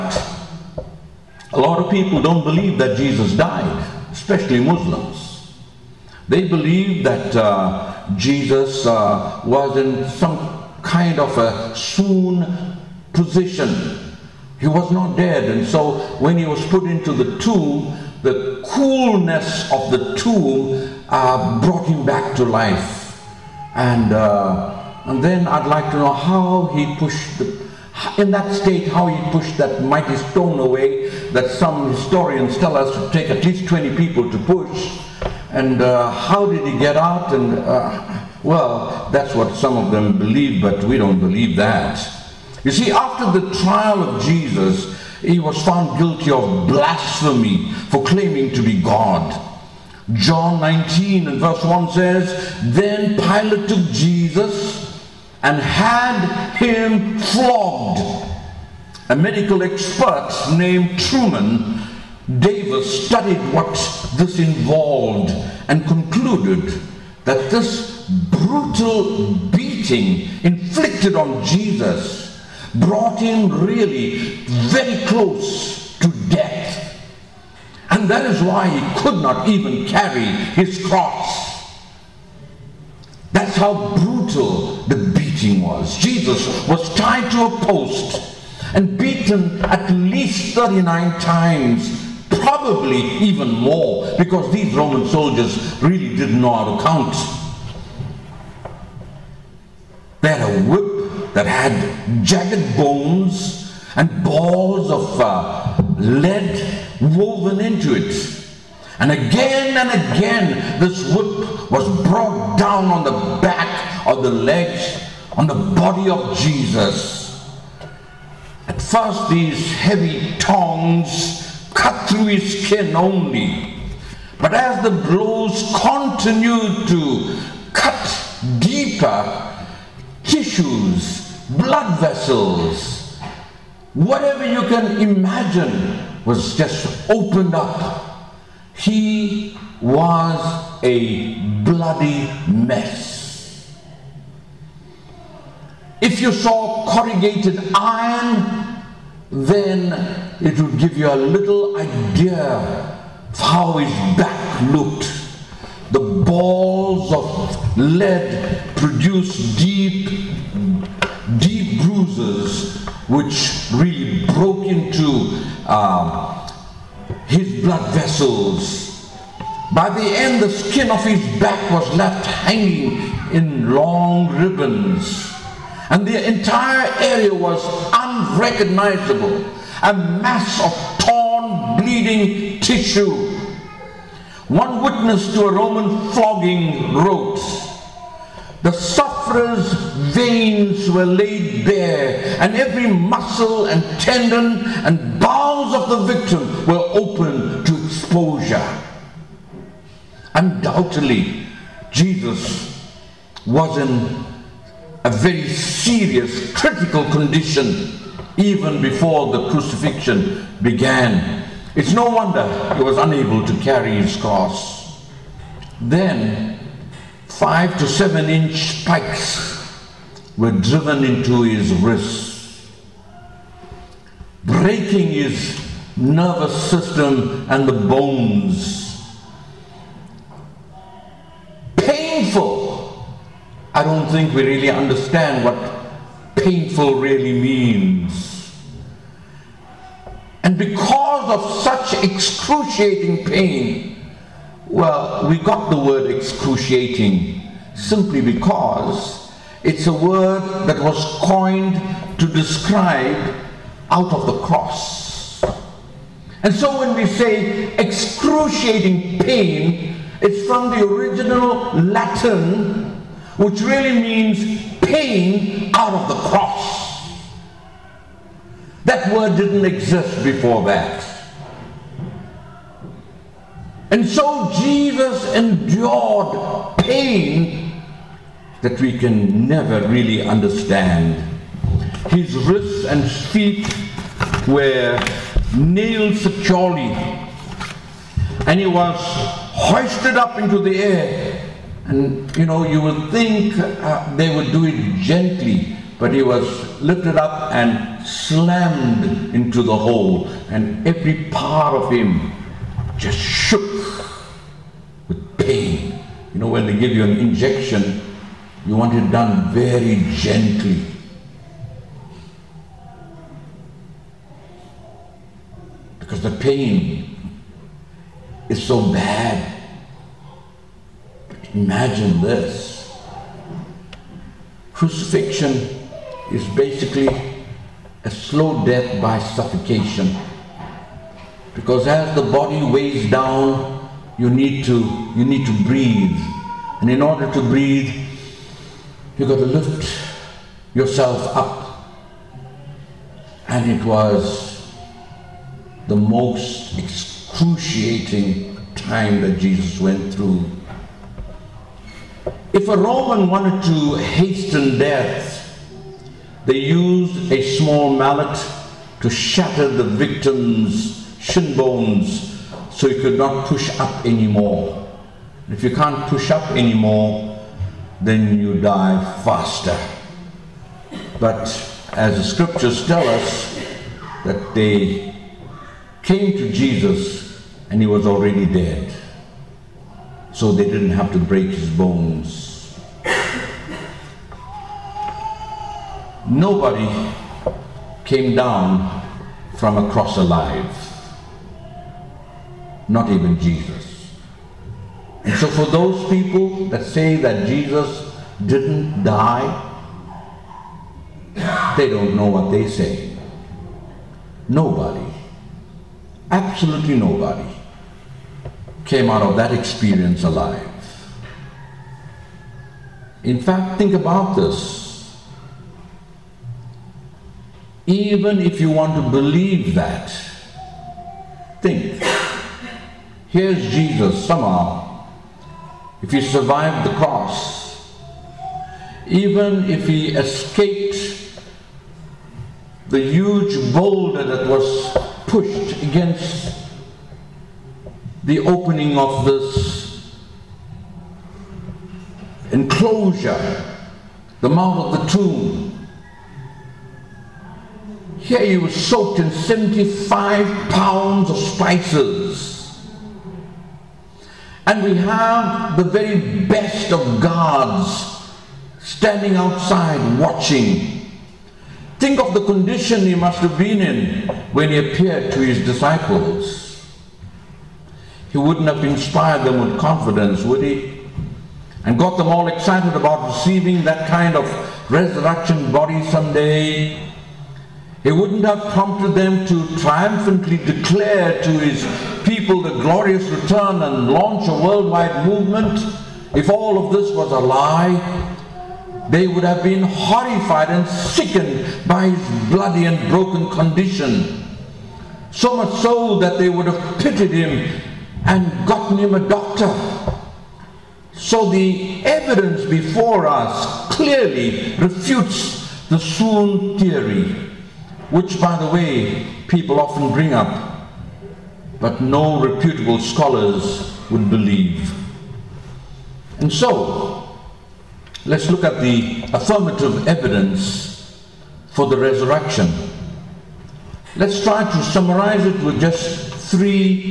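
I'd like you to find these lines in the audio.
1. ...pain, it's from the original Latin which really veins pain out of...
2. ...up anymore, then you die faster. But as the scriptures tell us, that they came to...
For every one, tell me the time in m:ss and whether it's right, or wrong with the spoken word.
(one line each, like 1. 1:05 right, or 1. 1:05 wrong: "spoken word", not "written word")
1. 4:19 wrong: "means", not "veins"
2. 6:06 right.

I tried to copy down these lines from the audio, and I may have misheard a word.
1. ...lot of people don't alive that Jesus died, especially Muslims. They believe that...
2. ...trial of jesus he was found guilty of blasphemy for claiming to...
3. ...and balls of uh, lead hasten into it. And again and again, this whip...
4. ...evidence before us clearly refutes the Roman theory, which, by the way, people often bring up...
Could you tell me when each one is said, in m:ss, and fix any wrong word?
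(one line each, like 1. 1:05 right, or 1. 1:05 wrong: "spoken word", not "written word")
1. 0:01 wrong: "believe", not "alive"
2. 0:43 right
3. 1:43 wrong: "woven", not "hasten"
4. 8:22 wrong: "Swoon", not "Roman".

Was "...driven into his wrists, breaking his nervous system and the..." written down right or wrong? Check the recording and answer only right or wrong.
right.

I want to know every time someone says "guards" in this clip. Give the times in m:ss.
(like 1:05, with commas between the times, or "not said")
7:37.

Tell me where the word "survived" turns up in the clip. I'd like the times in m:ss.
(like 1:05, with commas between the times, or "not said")
7:06.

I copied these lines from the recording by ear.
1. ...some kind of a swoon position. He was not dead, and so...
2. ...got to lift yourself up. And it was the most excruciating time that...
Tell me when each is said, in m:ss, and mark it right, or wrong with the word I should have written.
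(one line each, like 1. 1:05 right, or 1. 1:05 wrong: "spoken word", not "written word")
1. 0:10 right
2. 5:39 right.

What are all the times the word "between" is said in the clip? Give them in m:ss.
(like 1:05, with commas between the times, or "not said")
not said.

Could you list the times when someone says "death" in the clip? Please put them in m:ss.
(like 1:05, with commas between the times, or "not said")
1:16, 5:28, 5:54.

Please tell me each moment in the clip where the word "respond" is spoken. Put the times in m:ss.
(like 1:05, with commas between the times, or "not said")
not said.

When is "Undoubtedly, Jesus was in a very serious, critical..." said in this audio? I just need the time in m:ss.
3:20.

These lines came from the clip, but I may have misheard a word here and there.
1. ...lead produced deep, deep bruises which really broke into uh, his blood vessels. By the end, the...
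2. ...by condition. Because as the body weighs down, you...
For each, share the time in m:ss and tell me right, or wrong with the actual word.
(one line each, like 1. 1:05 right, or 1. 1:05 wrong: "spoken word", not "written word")
1. 2:37 right
2. 5:29 wrong: "suffocation", not "condition".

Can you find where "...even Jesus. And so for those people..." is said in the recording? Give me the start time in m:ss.
6:33.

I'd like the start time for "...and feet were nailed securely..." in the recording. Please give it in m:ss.
4:42.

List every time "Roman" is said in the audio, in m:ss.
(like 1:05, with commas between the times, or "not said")
1:34, 3:05, 5:52.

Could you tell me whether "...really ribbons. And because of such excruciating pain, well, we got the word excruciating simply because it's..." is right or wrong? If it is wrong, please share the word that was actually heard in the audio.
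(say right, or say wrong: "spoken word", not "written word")
wrong: "means", not "ribbons".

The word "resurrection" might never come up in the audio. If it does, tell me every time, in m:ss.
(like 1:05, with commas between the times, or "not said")
7:54, 8:41.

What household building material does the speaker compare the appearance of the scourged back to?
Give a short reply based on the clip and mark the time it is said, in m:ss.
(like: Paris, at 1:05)
Corrugated iron, at 2:26.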